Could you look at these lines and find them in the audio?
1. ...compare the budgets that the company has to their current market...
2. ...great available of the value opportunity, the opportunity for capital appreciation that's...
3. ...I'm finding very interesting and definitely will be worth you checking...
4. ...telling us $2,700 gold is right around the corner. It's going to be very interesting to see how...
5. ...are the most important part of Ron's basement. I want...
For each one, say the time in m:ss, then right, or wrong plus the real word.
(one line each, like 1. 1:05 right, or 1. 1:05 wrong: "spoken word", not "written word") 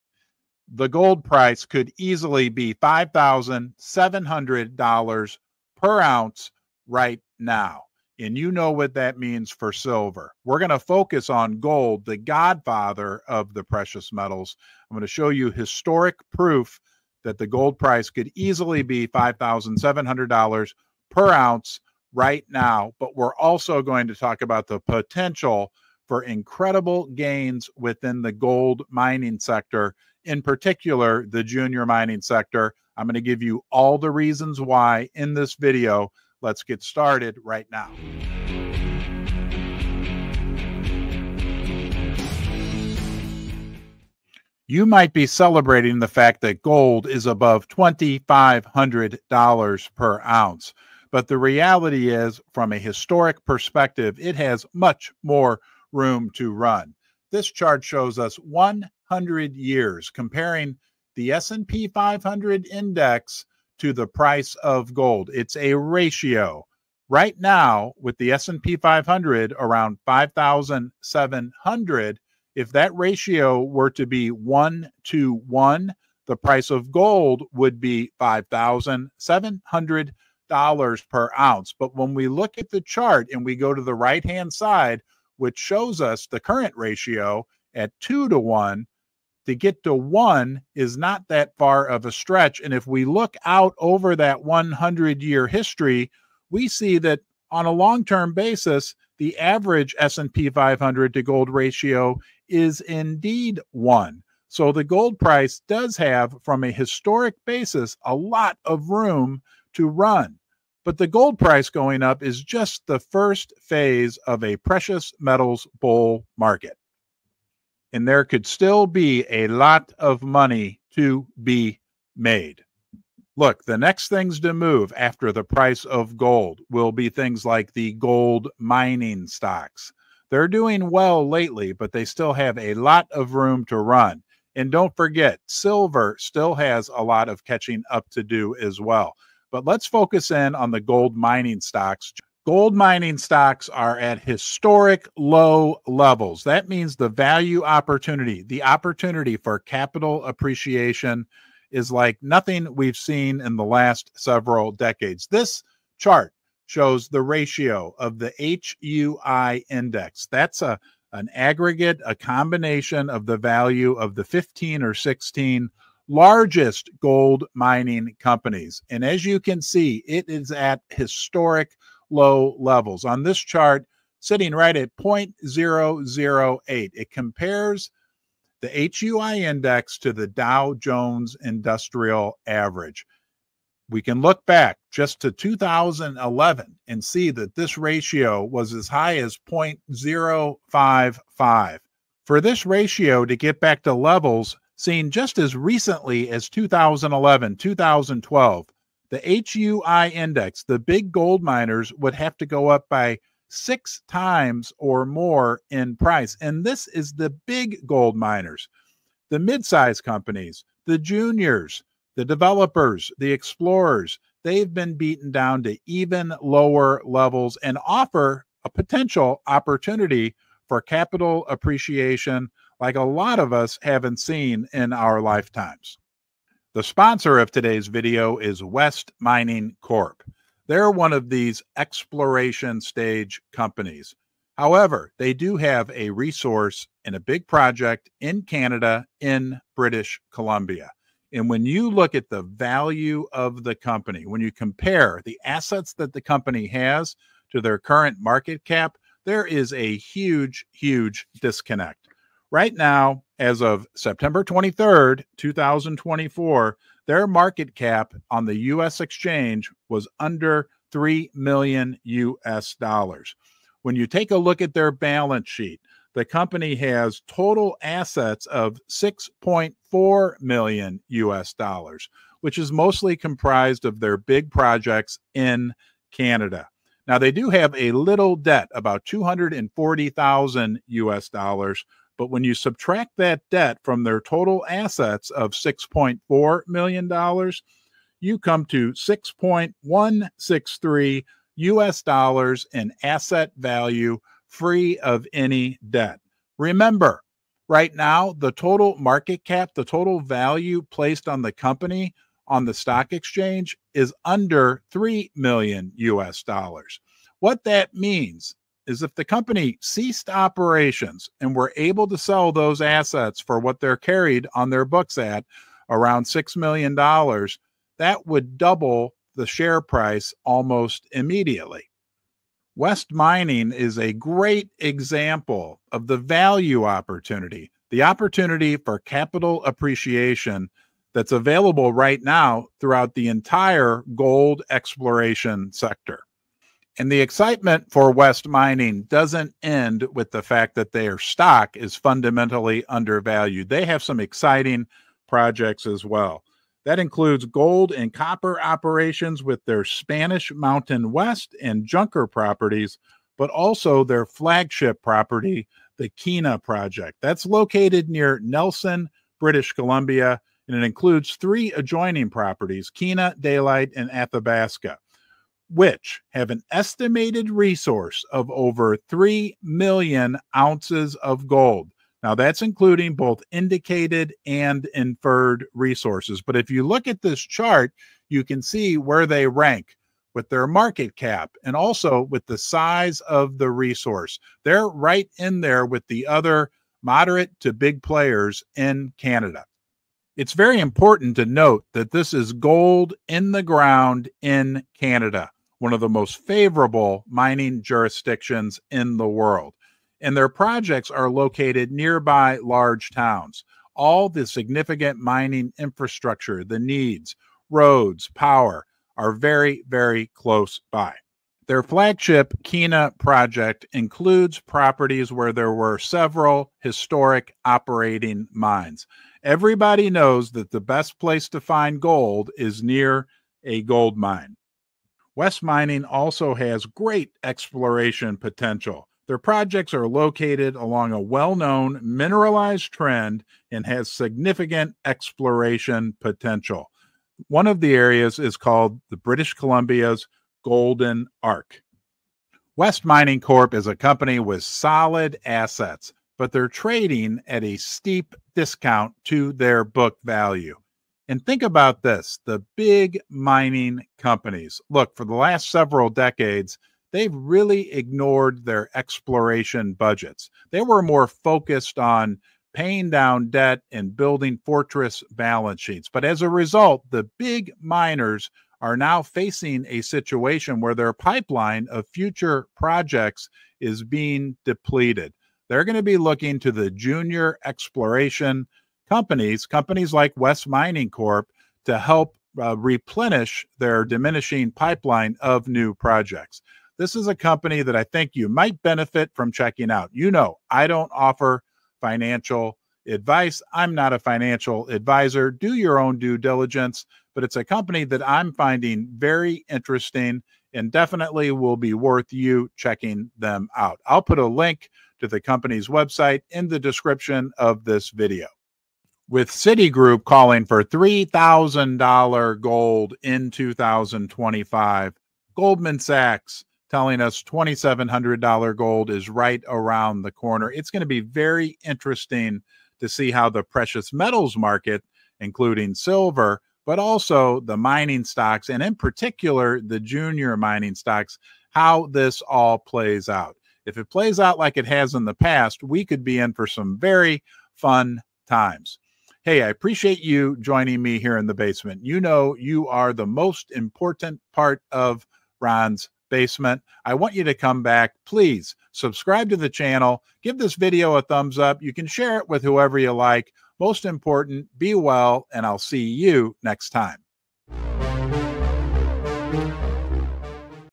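1. 4:04 wrong: "assets", not "budgets"
2. 5:24 wrong: "example", not "available"
3. 8:18 right
4. 8:36 right
5. 9:02 right.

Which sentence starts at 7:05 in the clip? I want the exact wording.
West Mining also has great exploration potential.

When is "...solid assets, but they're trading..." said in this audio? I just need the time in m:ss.
7:24.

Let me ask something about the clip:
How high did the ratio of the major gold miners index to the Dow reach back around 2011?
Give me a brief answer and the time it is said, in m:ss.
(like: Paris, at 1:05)
0.055, at 3:09.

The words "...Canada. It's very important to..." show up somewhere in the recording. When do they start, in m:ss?
6:29.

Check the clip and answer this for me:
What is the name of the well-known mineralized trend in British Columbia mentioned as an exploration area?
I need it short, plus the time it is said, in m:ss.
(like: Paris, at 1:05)
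Golden Arc, at 7:20.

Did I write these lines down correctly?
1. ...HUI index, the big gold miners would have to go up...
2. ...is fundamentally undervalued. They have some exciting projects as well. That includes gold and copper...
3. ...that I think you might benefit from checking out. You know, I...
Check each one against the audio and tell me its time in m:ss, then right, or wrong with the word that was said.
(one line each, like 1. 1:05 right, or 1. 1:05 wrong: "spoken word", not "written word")
1. 3:19 right
2. 5:41 right
3. 8:07 right.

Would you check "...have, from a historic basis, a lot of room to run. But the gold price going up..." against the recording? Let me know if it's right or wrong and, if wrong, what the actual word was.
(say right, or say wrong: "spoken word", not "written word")
right.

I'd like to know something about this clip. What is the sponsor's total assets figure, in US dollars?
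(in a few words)
$6.4 million.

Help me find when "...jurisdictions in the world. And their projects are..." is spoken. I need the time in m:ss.
6:37.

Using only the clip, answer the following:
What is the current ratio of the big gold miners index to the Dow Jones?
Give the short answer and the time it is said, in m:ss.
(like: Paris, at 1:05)
0.008, at 2:54.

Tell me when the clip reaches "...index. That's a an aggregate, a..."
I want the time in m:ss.
2:39.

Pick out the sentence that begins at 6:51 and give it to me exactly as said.
Their flagship Kena project includes properties where there were several historic operating mines.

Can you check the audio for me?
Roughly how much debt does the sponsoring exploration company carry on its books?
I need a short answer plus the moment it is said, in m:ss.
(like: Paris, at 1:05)
$240,000, at 4:39.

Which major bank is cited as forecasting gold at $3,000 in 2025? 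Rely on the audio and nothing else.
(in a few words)
Citigroup.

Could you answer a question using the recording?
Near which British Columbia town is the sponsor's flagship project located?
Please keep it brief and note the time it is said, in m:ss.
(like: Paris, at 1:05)
Nelson, at 5:58.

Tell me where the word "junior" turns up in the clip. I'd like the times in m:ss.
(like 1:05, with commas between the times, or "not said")
0:31, 3:30, 7:56, 8:50.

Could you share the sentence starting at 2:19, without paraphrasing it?
But let's focus in on the gold mining stocks Gold mining stocks are at historic low levels.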